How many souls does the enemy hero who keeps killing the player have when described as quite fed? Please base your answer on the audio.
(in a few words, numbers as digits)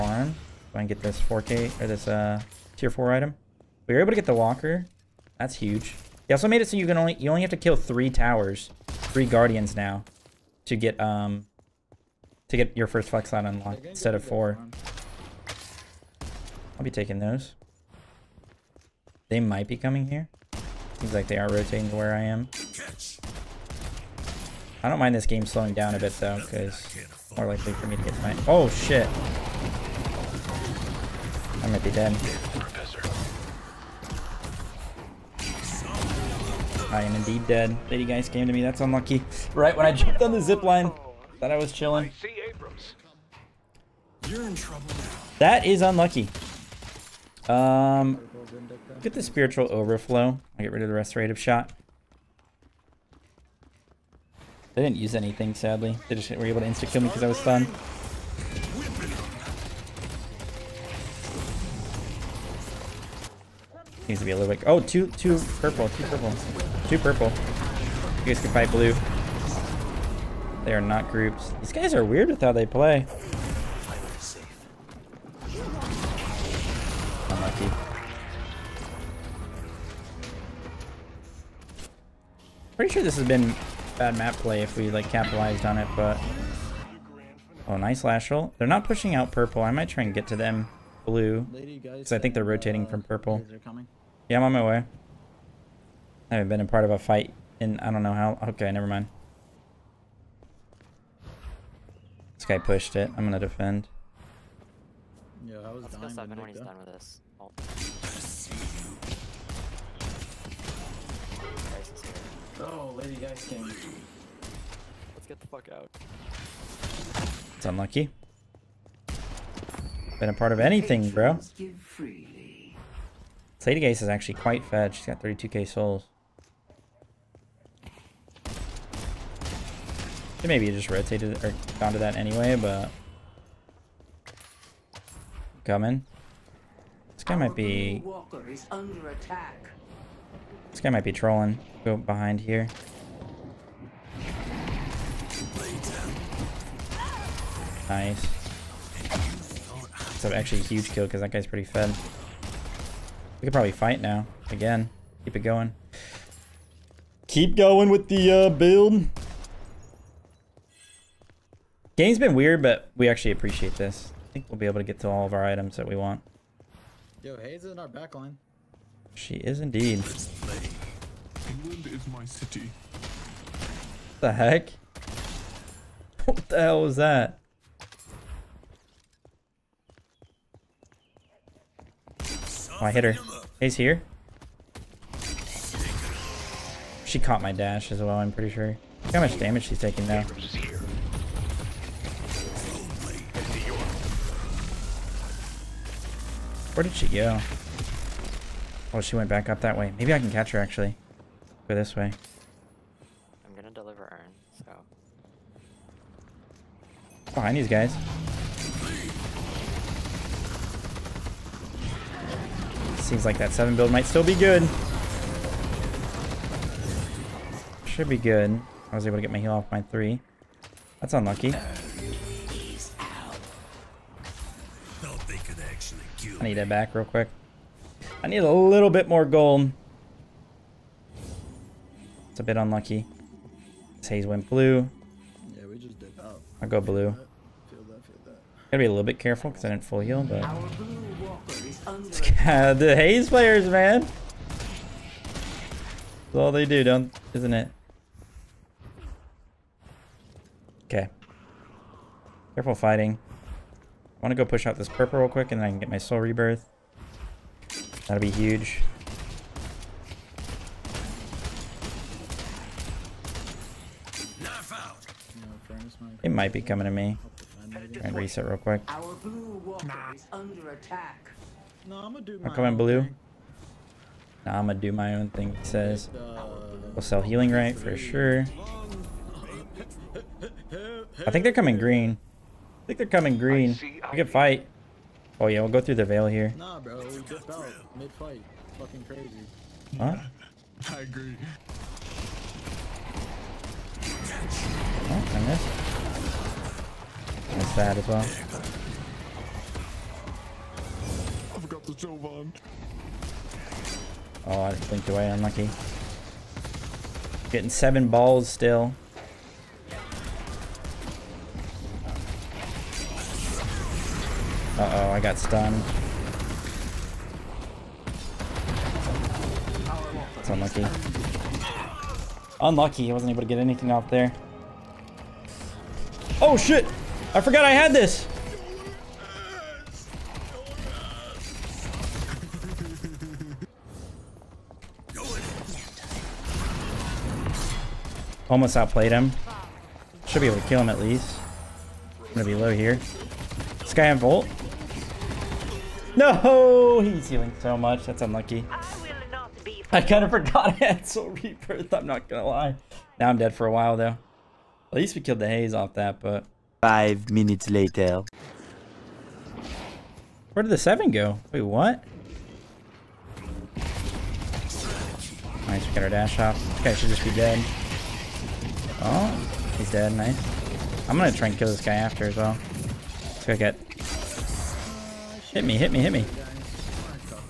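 32k.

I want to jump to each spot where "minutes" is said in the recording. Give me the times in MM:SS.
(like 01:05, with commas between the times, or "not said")
05:57.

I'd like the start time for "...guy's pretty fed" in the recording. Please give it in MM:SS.
02:31.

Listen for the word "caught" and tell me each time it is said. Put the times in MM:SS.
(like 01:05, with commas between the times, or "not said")
03:07.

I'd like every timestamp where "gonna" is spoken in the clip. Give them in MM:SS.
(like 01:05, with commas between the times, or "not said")
01:43, 03:23, 04:34, 05:42, 05:52, 06:11.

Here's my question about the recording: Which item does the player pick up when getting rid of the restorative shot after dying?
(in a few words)
Spiritual Overflow.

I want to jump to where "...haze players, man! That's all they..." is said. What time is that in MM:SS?
04:02.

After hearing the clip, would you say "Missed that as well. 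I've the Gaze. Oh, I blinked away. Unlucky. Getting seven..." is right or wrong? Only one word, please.
wrong.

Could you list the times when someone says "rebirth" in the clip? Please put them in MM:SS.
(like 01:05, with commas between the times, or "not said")
04:16, 05:51.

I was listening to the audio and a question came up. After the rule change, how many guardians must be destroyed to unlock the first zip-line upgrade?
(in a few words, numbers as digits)
3.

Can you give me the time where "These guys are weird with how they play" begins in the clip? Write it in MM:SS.
01:11.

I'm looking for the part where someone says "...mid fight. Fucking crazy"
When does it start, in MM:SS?
04:47.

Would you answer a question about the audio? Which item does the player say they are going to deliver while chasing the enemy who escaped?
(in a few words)
Urn.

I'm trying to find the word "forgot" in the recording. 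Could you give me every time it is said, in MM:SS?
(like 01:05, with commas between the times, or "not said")
05:27, 05:50.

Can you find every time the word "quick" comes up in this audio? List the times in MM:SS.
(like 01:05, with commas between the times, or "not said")
03:47, 04:15, 04:28.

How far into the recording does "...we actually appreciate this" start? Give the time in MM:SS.
02:42.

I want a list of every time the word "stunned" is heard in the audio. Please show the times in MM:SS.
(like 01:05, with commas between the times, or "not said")
00:57, 05:15.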